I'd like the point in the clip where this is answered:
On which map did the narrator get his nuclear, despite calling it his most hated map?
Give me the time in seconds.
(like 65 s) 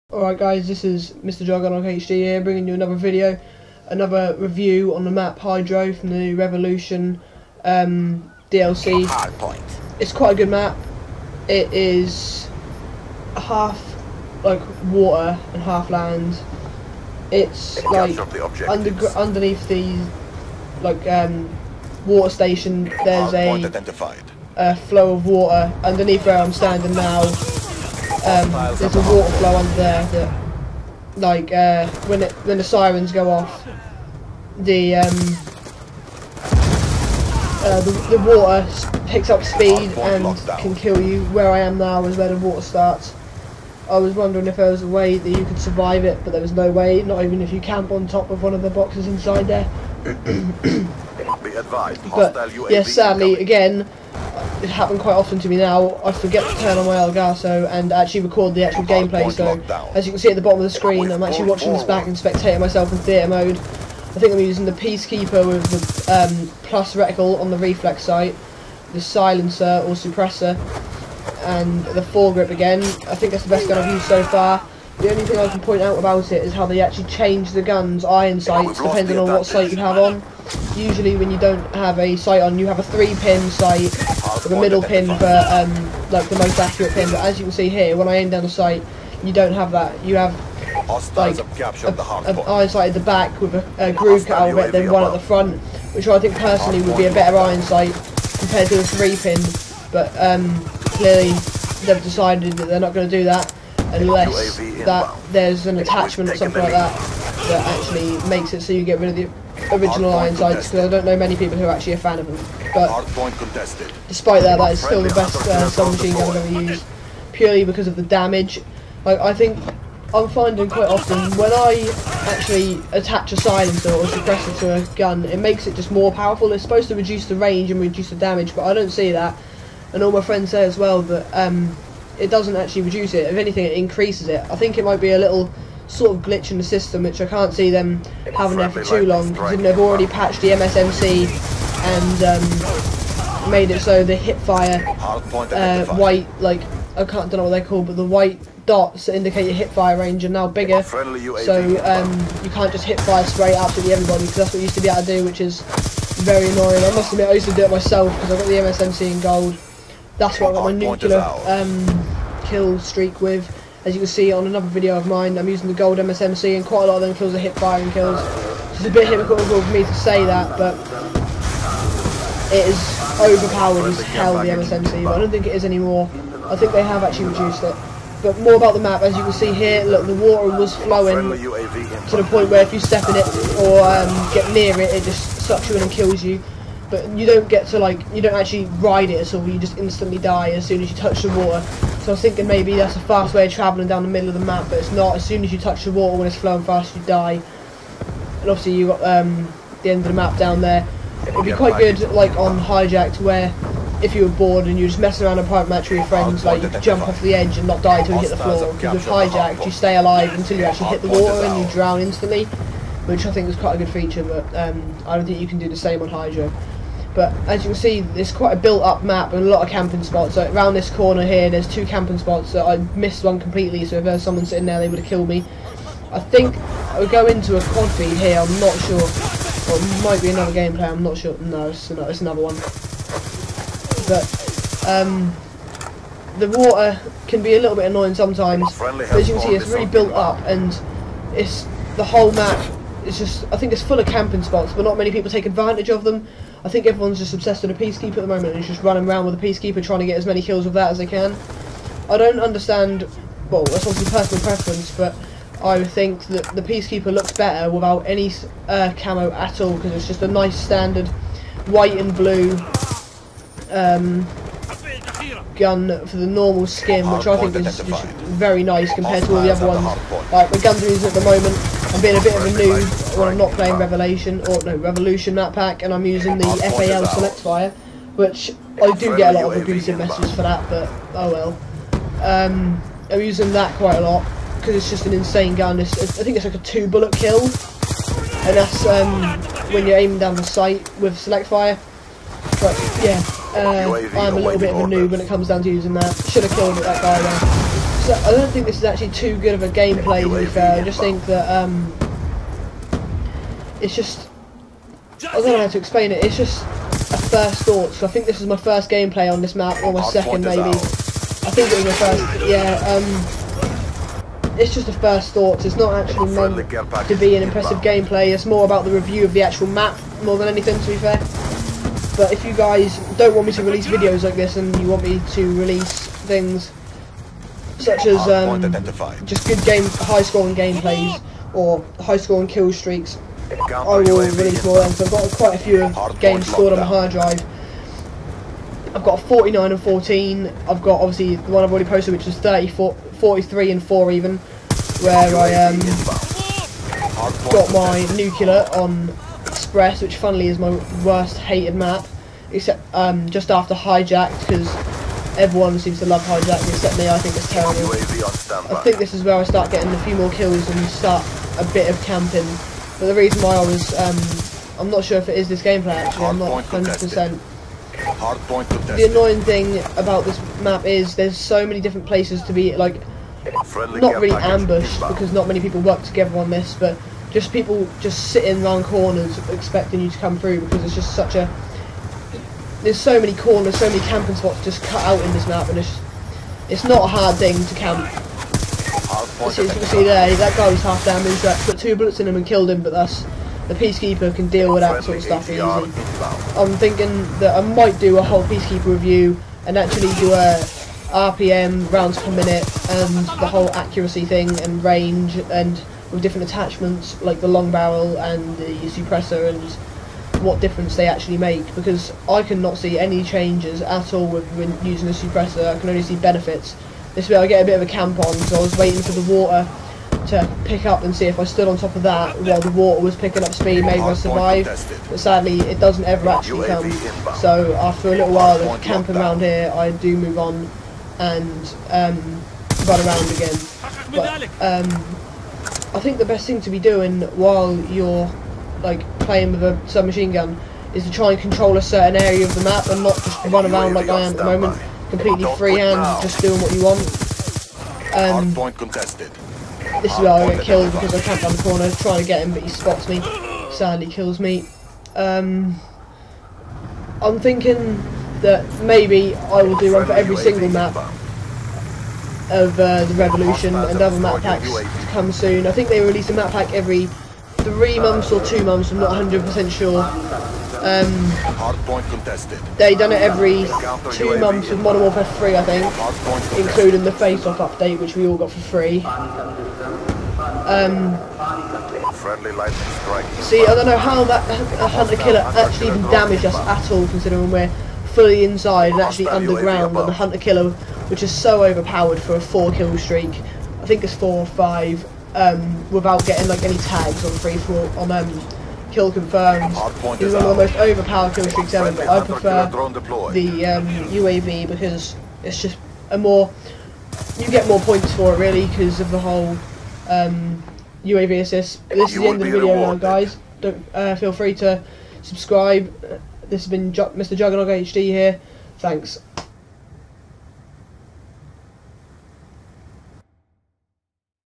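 349 s.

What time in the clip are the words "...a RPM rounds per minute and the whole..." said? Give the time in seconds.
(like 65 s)
400 s.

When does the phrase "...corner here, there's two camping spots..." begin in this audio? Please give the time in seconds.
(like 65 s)
220 s.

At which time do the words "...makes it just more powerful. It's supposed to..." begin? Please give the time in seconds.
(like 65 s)
125 s.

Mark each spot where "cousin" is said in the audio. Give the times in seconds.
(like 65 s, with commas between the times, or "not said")
not said.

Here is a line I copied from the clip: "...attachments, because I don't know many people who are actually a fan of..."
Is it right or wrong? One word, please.
wrong.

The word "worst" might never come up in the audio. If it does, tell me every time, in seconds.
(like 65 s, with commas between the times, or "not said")
351 s.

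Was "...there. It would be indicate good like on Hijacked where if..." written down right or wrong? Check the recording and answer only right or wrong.
wrong.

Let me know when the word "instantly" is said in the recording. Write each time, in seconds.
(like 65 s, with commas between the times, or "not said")
189 s, 212 s.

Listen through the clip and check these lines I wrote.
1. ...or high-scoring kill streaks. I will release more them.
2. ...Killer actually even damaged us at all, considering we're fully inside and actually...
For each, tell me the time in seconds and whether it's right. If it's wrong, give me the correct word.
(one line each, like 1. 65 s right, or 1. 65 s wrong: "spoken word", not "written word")
1. 331 s right
2. 485 s right.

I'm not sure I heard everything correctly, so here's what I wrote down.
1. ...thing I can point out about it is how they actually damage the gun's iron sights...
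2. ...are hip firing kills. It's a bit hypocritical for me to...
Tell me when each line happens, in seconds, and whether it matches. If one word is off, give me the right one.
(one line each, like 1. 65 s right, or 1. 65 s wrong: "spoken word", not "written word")
1. 75 s wrong: "change", not "damage"
2. 167 s right.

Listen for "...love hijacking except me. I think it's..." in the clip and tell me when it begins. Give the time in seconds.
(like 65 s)
356 s.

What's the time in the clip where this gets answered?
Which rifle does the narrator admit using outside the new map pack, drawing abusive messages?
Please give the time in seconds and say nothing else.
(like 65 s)
276 s.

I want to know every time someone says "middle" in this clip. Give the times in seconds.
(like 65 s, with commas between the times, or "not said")
84 s, 194 s.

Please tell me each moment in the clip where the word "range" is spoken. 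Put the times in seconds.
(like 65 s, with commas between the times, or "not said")
127 s, 149 s, 404 s.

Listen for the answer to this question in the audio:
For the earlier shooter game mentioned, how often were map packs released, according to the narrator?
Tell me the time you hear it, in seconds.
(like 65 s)
473 s.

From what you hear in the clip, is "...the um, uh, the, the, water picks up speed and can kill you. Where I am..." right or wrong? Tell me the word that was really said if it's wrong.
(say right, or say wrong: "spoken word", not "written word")
right.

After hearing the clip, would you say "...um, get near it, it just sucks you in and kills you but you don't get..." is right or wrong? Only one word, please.
right.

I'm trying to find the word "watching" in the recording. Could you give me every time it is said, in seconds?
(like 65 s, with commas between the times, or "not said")
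61 s.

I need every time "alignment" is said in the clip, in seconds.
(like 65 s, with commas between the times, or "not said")
not said.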